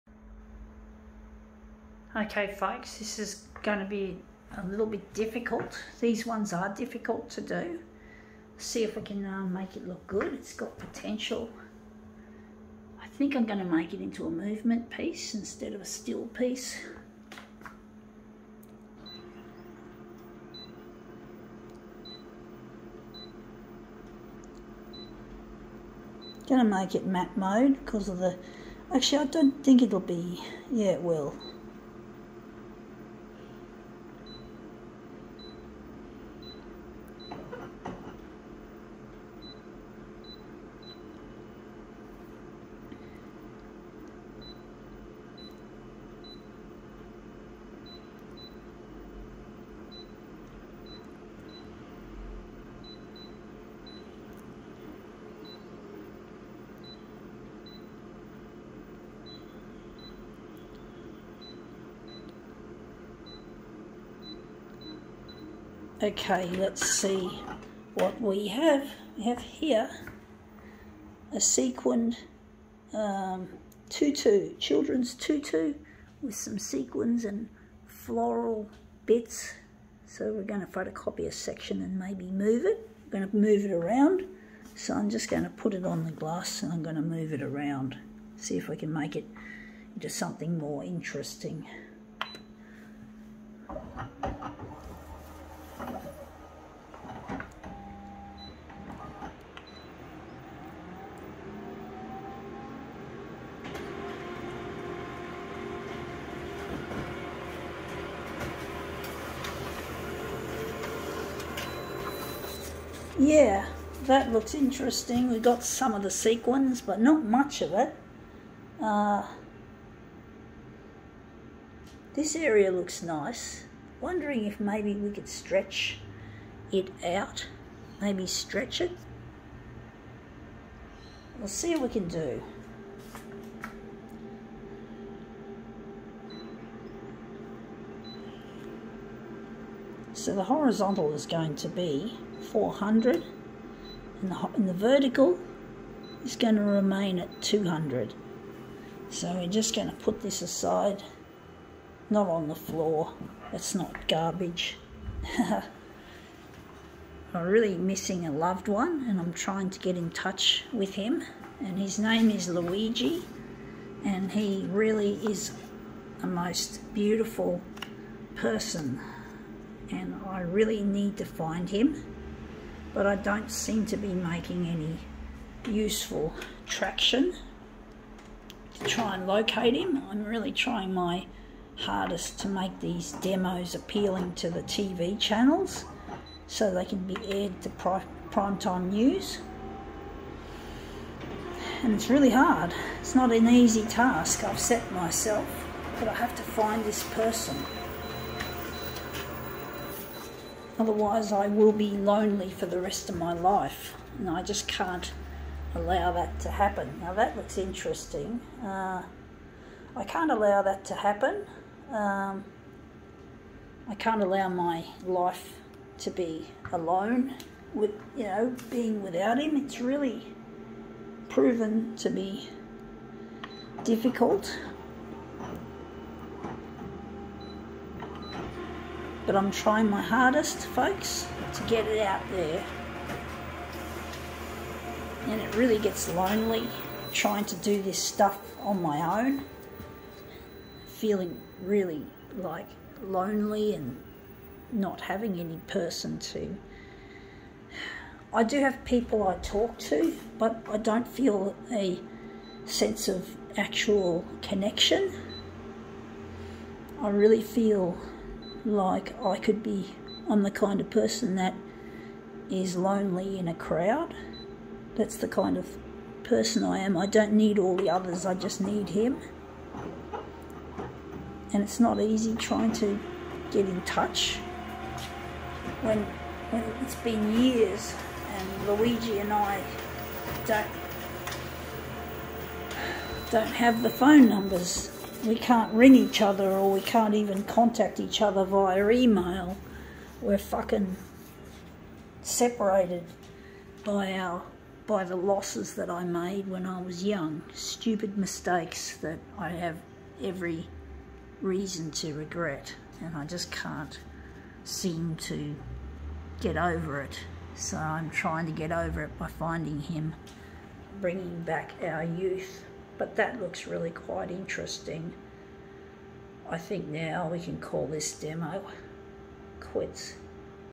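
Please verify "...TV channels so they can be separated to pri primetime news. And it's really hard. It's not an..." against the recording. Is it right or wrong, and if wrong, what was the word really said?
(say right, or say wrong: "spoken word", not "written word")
wrong: "aired", not "separated".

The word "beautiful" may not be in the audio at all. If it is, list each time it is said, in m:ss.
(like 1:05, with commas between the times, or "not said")
2:46.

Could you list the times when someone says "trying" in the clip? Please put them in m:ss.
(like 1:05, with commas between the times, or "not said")
2:39, 3:00, 3:49, 3:57, 4:32, 5:08.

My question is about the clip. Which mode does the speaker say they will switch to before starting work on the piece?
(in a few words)
matte mode.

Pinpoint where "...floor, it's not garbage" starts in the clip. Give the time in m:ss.
2:32.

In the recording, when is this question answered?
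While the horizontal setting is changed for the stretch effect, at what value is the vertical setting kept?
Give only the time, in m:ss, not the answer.
2:27.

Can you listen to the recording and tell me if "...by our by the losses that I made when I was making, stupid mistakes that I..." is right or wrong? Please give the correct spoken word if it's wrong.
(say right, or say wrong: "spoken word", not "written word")
wrong: "young", not "making".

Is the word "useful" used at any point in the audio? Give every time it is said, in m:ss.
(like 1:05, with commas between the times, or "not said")
2:55.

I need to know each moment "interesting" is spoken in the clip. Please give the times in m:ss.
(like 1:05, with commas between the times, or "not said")
1:30, 1:54, 3:27, 5:14.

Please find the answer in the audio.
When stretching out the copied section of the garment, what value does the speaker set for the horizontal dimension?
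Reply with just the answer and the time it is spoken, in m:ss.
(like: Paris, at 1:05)
400, at 2:22.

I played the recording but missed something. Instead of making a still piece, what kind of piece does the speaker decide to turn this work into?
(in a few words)
movement piece.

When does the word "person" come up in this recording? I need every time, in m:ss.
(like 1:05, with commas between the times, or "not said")
2:48, 3:17, 4:05, 4:20, 4:26.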